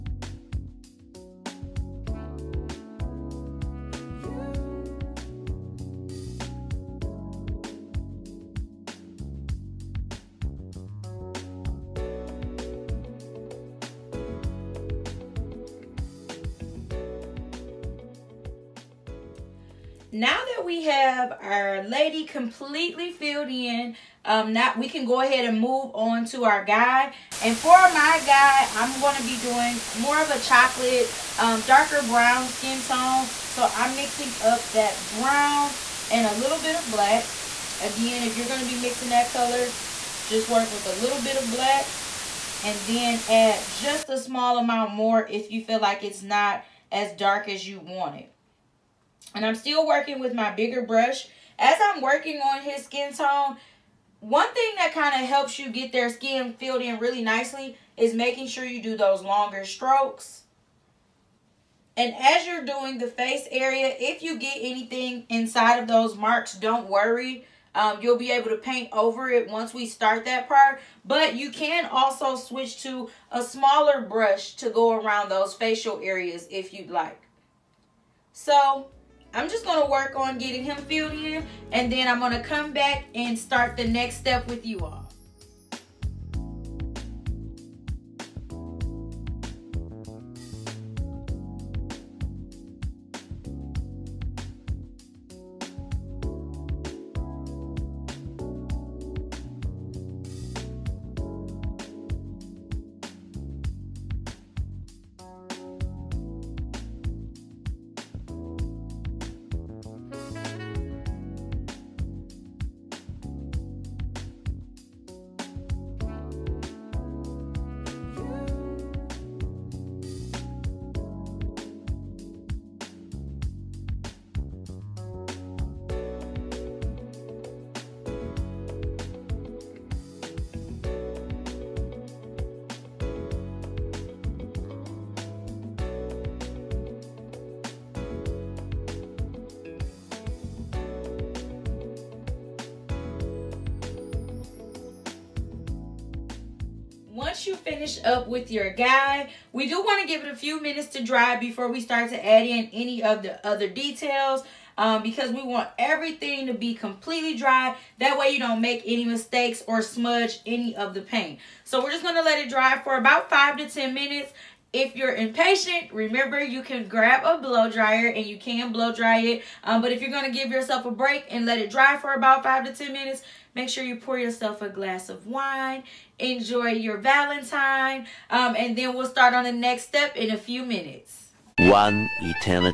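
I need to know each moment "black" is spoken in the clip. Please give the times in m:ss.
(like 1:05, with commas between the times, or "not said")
0:36, 0:41.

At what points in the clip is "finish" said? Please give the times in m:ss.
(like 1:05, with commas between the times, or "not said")
2:27.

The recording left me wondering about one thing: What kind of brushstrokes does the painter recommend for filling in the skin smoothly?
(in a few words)
longer strokes.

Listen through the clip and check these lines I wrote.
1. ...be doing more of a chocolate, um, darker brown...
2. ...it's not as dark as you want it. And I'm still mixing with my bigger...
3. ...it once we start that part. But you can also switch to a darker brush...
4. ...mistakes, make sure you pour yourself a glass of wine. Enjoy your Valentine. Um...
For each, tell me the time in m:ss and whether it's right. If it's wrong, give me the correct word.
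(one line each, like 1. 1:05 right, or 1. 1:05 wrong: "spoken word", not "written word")
1. 0:29 right
2. 0:46 wrong: "working", not "mixing"
3. 1:09 wrong: "smaller", not "darker"
4. 2:52 wrong: "minutes", not "mistakes".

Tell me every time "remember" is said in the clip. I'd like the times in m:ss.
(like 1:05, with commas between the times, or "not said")
2:45.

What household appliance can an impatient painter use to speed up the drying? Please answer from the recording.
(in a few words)
blow dryer.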